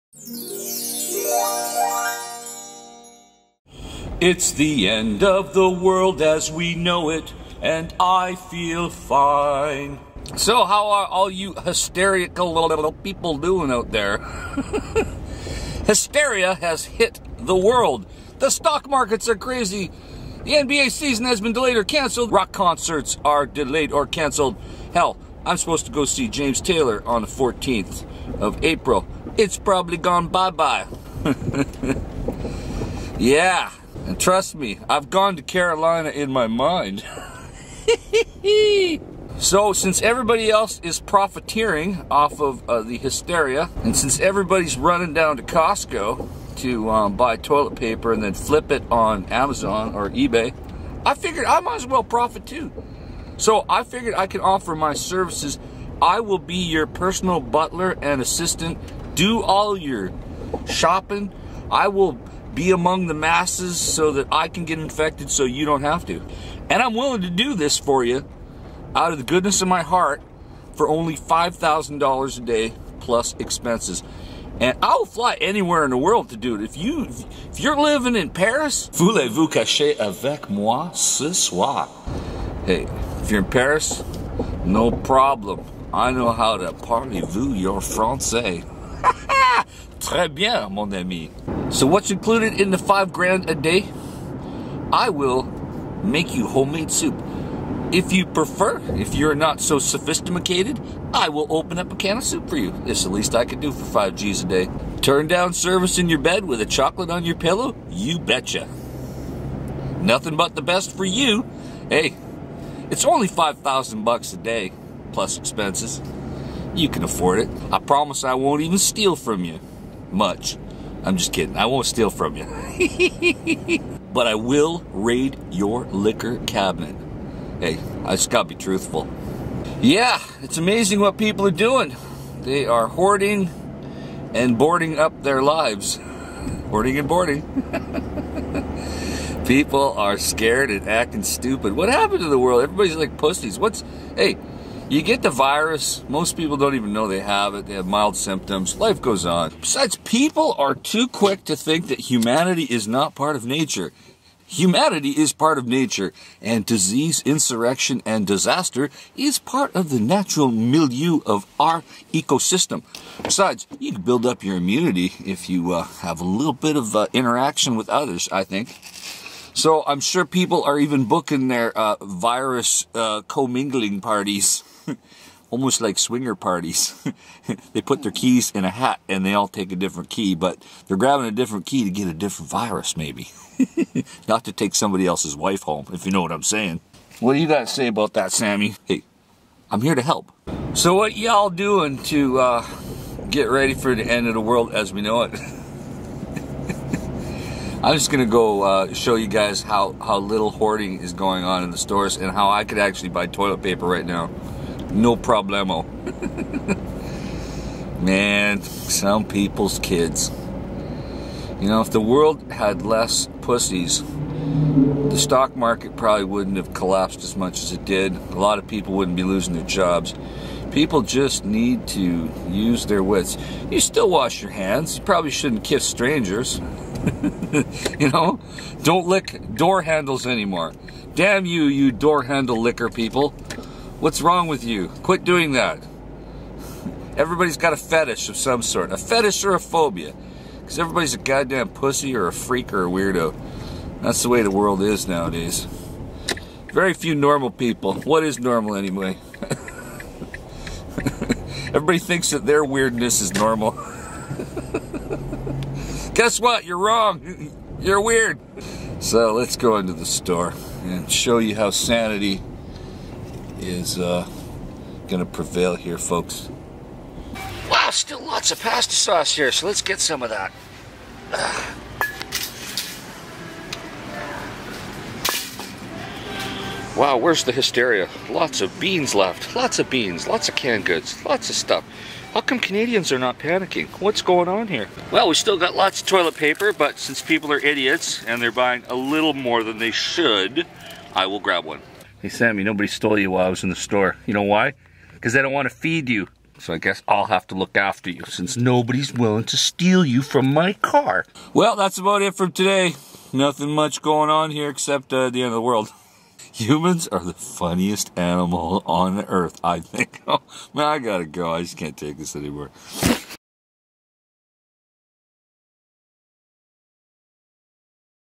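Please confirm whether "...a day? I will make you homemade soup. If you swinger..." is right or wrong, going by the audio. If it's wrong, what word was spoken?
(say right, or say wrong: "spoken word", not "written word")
wrong: "prefer", not "swinger".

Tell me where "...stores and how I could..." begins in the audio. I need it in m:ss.
3:21.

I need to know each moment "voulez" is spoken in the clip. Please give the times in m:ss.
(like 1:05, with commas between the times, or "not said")
1:18.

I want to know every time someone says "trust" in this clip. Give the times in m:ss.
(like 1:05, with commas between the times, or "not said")
0:34.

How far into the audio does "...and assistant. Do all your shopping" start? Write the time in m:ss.
0:58.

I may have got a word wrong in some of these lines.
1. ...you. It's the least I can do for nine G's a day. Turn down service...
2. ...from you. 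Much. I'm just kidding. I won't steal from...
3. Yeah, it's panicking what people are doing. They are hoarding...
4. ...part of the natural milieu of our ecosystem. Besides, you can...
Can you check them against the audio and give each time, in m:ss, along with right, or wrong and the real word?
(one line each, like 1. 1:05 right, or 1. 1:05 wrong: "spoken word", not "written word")
1. 1:42 wrong: "five", not "nine"
2. 1:59 right
3. 2:09 wrong: "amazing", not "panicking"
4. 2:39 right.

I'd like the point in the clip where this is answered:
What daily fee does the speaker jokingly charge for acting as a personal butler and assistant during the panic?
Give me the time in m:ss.
1:11.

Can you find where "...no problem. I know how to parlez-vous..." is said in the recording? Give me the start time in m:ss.
1:24.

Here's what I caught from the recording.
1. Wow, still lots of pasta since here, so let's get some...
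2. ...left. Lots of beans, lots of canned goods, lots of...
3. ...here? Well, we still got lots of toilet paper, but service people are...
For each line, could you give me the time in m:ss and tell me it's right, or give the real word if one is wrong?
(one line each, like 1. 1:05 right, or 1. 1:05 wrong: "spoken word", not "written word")
1. 4:27 wrong: "sauce", not "since"
2. 4:39 right
3. 4:44 wrong: "since", not "service".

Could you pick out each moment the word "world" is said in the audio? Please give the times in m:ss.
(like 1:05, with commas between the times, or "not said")
0:05, 0:17, 1:15, 2:22, 3:14, 3:32, 4:04, 5:05.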